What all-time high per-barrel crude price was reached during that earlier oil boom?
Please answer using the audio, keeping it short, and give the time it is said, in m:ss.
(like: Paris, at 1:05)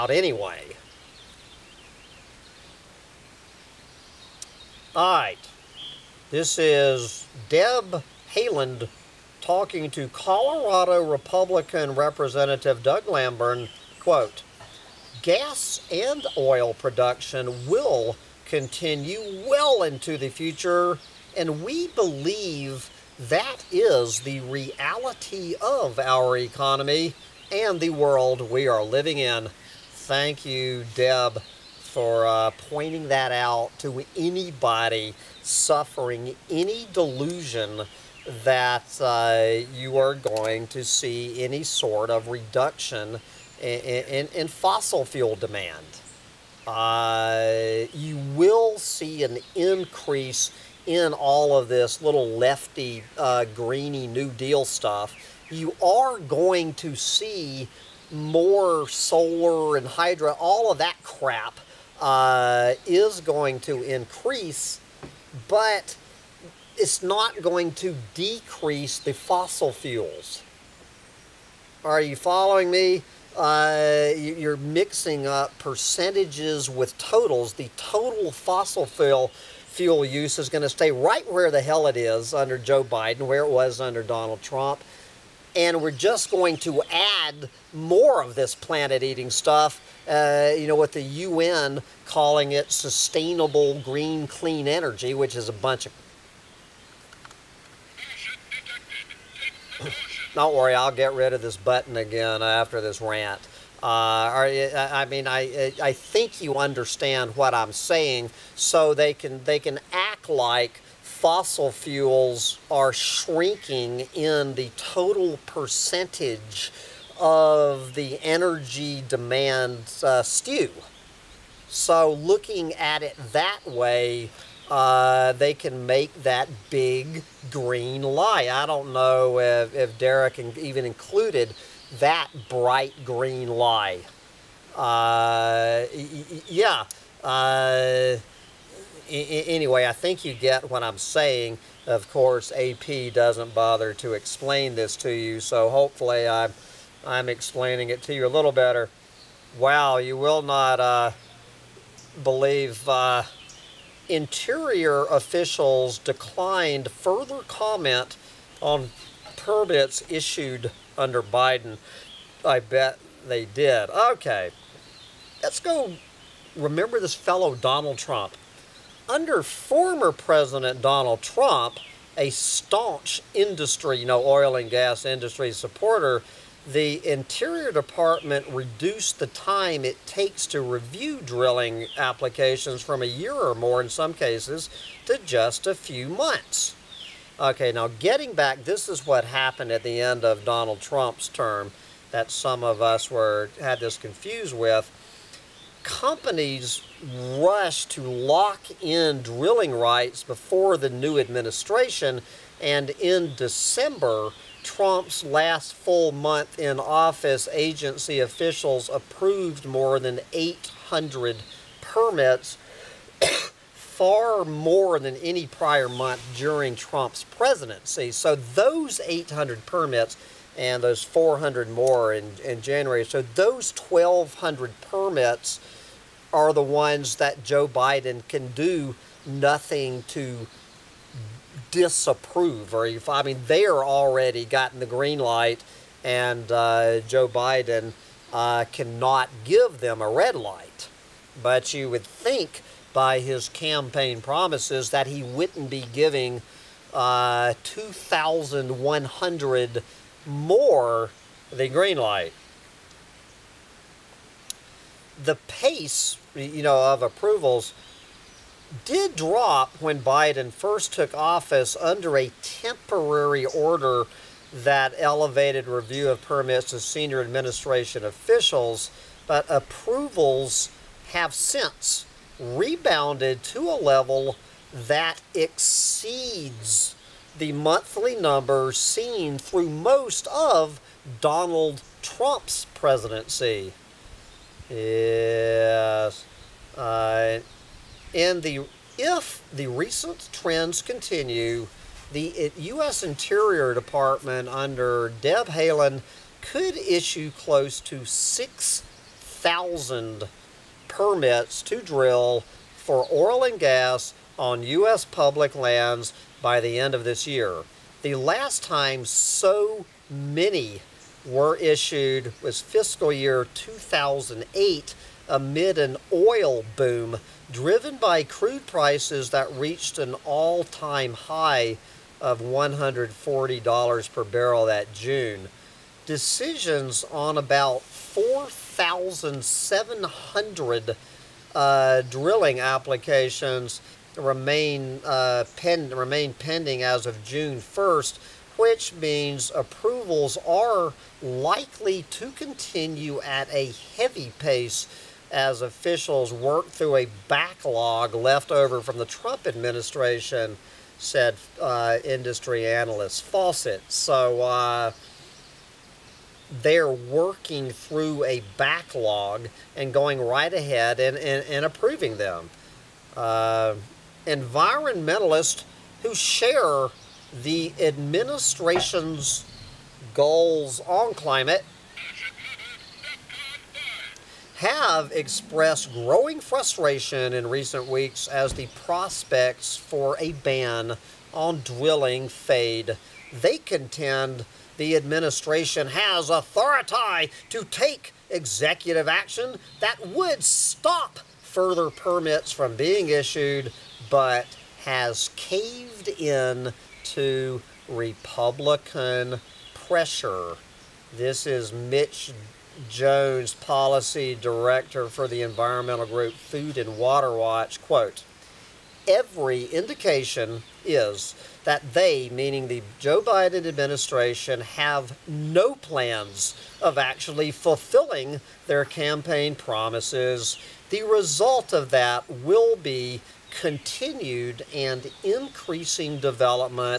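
$140, at 5:22.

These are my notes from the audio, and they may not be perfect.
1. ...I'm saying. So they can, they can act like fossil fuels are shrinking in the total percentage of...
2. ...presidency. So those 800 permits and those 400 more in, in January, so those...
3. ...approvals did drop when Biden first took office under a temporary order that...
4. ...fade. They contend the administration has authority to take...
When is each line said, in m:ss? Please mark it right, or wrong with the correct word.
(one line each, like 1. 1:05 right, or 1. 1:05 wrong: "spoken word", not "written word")
1. 1:47 right
2. 3:37 right
3. 4:17 right
4. 6:22 right.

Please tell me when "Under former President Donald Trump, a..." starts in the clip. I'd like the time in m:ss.
2:49.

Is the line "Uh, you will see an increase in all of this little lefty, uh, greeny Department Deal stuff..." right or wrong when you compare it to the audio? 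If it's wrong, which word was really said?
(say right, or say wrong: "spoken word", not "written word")
wrong: "New", not "Department".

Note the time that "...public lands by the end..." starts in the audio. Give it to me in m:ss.
5:05.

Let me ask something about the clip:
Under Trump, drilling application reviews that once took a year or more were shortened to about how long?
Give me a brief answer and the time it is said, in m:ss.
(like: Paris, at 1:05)
a few months, at 3:05.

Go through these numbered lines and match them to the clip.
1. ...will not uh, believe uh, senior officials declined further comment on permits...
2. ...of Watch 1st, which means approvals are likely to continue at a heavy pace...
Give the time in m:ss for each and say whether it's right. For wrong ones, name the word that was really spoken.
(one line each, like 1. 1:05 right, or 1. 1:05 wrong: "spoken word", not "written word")
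1. 2:30 wrong: "interior", not "senior"
2. 5:37 wrong: "June", not "Watch".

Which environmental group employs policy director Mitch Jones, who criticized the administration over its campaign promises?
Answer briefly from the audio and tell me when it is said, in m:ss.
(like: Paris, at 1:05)
Food and Water Watch, at 6:46.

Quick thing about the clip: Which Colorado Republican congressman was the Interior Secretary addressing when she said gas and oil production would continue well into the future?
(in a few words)
Doug Lamborn.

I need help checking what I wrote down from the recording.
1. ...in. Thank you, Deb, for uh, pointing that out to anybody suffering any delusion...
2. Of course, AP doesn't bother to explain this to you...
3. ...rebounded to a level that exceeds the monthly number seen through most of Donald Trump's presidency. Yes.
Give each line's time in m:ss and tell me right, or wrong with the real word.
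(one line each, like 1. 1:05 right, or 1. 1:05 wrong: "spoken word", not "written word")
1. 0:29 right
2. 2:21 right
3. 4:32 right.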